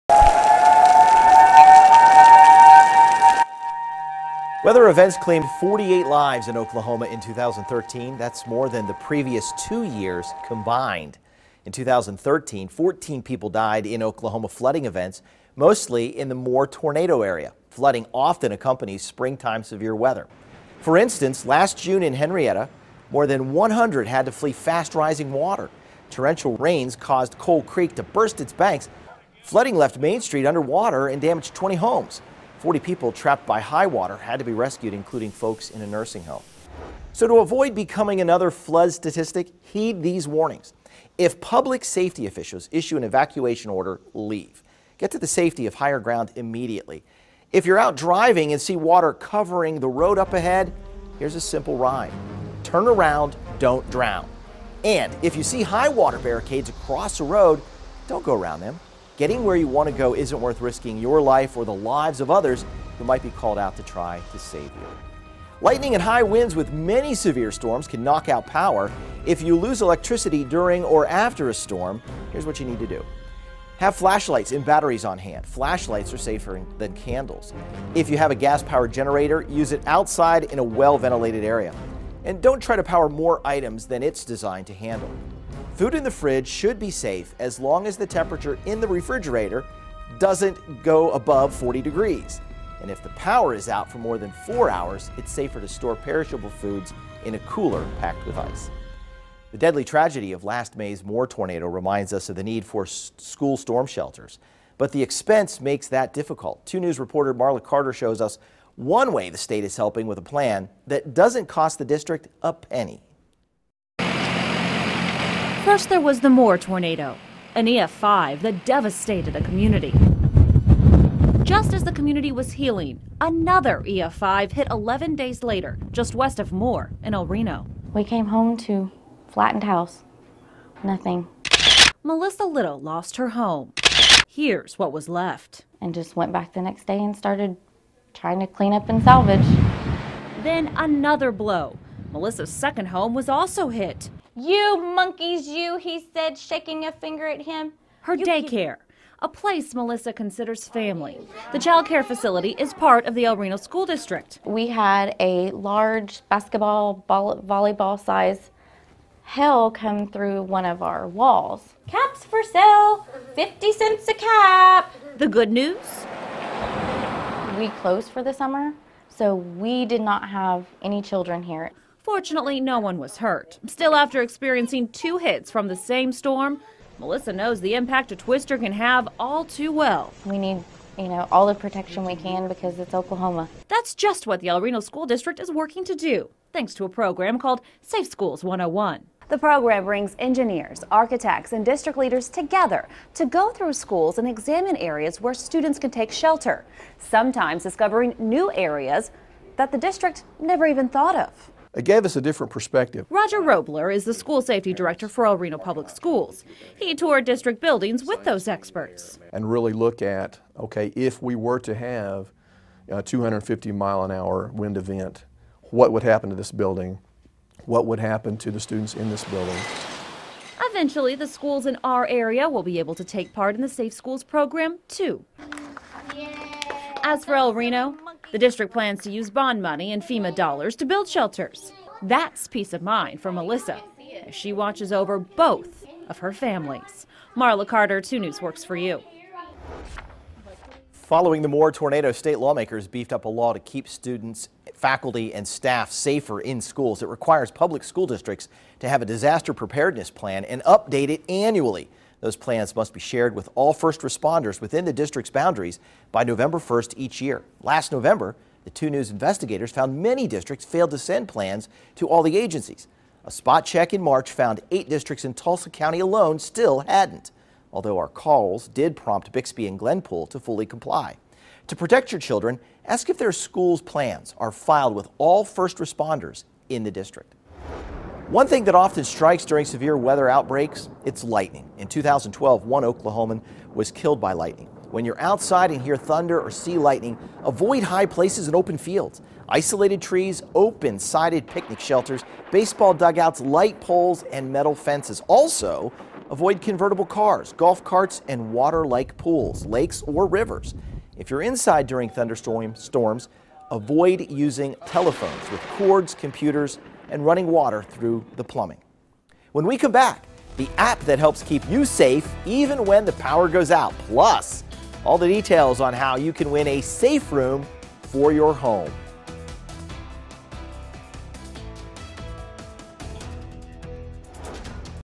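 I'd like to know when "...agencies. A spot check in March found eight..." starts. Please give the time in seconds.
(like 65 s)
262 s.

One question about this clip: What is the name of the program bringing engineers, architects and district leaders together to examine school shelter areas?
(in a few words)
Safe Schools 101.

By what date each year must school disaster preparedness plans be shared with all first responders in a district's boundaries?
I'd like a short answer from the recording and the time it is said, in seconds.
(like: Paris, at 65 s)
November 1, at 256 s.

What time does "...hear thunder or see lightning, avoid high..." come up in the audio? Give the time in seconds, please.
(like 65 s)
285 s.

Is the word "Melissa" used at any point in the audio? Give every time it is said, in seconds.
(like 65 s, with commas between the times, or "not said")
132 s, 142 s, 149 s, 176 s, 233 s.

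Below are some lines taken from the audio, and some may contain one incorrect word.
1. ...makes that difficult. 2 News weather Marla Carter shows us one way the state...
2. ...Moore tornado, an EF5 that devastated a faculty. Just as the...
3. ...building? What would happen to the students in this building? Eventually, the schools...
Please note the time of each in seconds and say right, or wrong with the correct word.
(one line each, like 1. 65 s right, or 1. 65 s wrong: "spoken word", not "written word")
1. 105 s wrong: "reporter", not "weather"
2. 116 s wrong: "community", not "faculty"
3. 216 s right.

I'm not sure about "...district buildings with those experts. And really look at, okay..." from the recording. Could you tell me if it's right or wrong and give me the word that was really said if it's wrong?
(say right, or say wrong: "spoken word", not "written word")
right.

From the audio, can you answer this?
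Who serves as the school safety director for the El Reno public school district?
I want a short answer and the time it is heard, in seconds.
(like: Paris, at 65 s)
Roger Robler, at 203 s.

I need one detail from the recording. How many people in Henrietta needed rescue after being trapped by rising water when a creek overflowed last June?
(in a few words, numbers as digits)
40.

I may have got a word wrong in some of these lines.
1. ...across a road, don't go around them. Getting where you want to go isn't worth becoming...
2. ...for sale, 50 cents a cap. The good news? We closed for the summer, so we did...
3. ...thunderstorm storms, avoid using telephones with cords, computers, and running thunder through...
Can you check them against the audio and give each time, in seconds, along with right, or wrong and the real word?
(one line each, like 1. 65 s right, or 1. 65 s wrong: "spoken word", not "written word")
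1. 56 s wrong: "risking", not "becoming"
2. 162 s right
3. 302 s wrong: "water", not "thunder".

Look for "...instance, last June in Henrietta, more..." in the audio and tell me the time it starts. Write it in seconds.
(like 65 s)
20 s.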